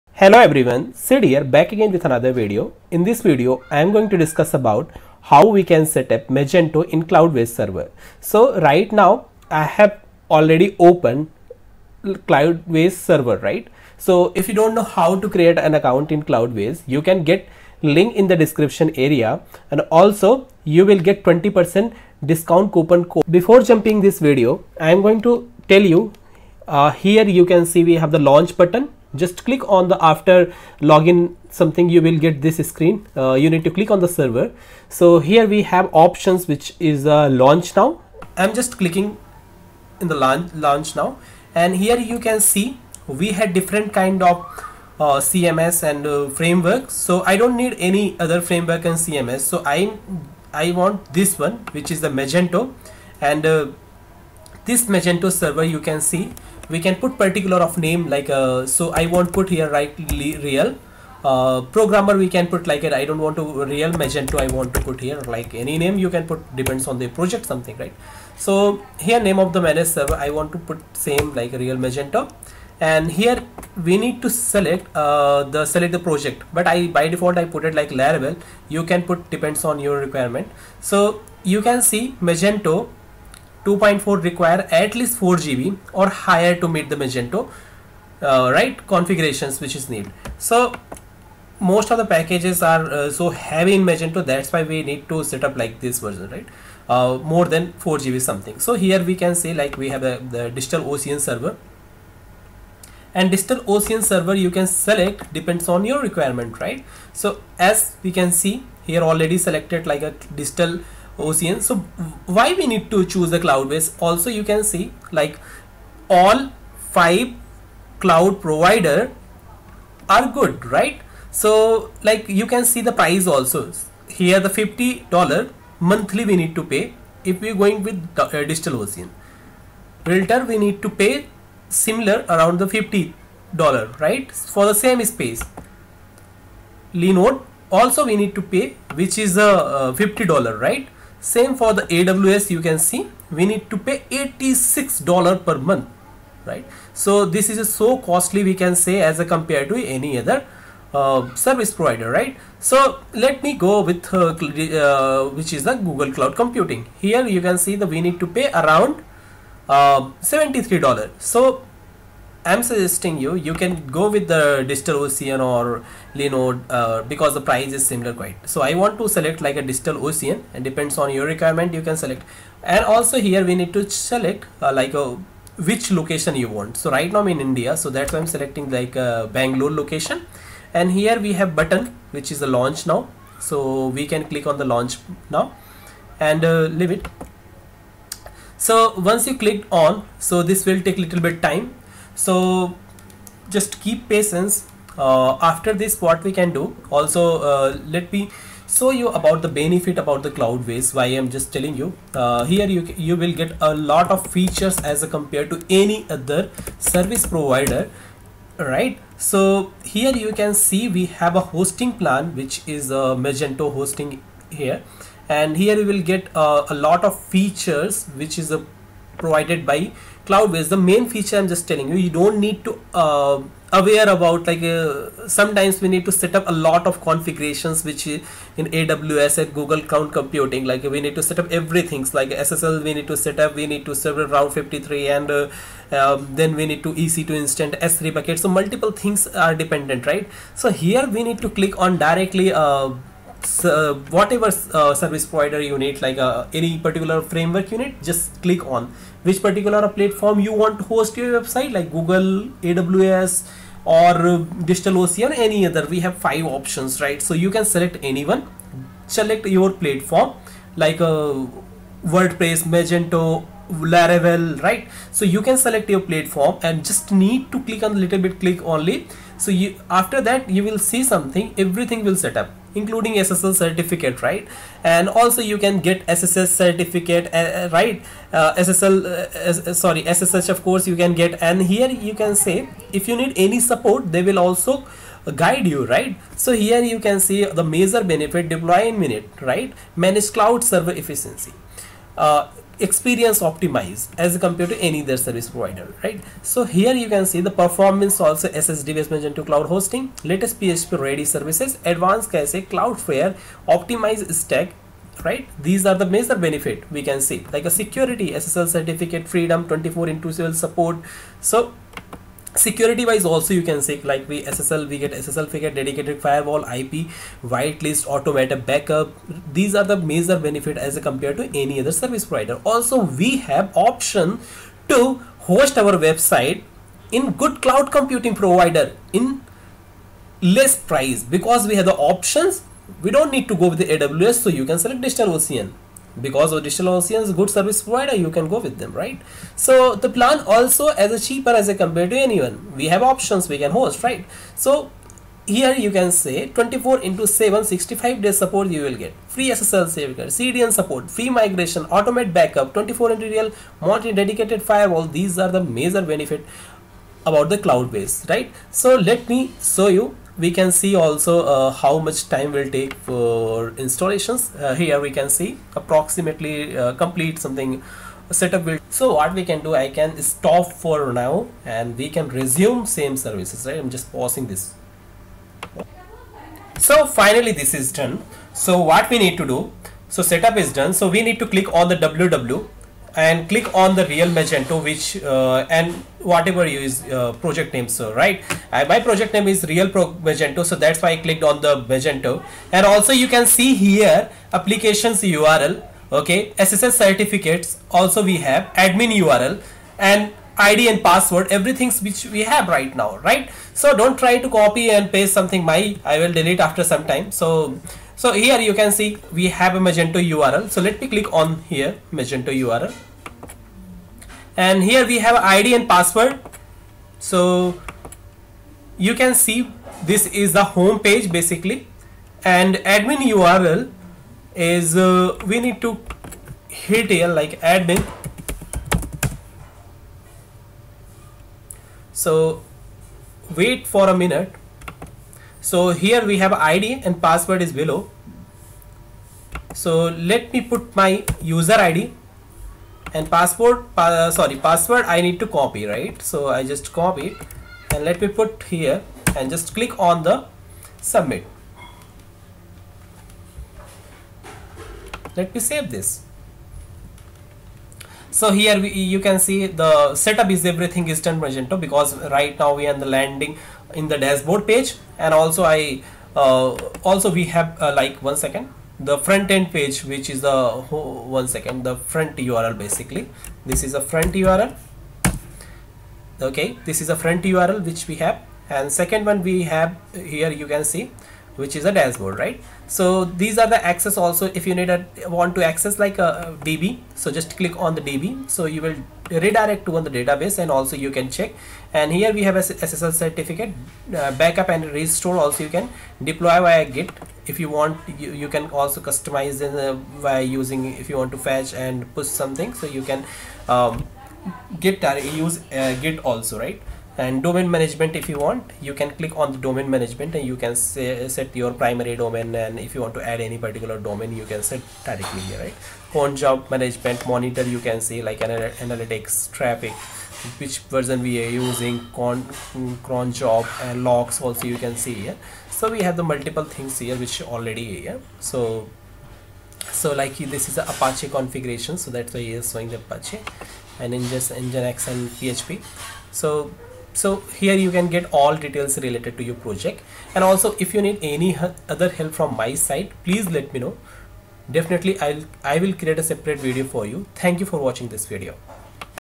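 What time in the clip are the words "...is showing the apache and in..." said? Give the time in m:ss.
8:52.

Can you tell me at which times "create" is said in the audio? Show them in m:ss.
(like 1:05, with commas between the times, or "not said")
0:15, 9:05.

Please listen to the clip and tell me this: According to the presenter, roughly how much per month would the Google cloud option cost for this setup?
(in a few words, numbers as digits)
$73.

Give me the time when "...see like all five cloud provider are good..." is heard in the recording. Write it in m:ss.
1:54.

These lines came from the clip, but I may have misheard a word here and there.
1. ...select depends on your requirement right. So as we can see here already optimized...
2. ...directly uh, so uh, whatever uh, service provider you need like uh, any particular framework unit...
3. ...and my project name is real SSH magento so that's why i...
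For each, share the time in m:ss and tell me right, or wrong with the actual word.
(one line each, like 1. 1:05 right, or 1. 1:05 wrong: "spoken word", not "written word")
1. 1:44 wrong: "selected", not "optimized"
2. 4:02 right
3. 6:28 wrong: "Pro", not "SSH".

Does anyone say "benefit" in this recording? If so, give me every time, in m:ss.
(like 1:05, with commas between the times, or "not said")
3:19, 4:48, 5:06, 5:20, 5:56.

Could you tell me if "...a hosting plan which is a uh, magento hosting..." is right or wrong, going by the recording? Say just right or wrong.
right.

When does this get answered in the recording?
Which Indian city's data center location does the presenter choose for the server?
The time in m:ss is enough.
2:59.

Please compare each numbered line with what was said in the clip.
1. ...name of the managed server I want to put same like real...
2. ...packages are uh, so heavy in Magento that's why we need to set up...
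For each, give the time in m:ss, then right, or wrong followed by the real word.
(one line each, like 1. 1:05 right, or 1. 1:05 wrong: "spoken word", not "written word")
1. 1:09 right
2. 1:32 right.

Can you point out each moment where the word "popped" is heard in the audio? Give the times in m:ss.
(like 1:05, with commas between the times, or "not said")
not said.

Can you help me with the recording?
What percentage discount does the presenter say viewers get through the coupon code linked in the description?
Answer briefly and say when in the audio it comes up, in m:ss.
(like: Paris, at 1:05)
20%, at 0:21.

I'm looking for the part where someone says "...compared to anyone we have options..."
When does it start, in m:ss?
5:41.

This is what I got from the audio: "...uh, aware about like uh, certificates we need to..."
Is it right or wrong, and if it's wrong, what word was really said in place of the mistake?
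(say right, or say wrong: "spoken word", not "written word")
wrong: "sometimes", not "certificates".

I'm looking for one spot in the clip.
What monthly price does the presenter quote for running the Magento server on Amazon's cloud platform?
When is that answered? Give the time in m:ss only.
2:24.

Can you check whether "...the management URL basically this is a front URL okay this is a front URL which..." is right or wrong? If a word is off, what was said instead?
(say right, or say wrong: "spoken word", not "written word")
wrong: "front", not "management".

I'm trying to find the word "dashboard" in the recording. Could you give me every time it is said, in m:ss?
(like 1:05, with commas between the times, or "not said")
7:44, 8:01.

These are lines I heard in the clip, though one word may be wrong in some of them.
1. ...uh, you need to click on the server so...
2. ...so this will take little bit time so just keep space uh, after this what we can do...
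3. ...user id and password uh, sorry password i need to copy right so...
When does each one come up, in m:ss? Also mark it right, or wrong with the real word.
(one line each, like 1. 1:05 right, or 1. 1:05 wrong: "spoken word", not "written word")
1. 0:33 right
2. 3:10 wrong: "patience", not "space"
3. 7:21 right.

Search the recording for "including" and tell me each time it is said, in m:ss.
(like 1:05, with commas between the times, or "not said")
4:32.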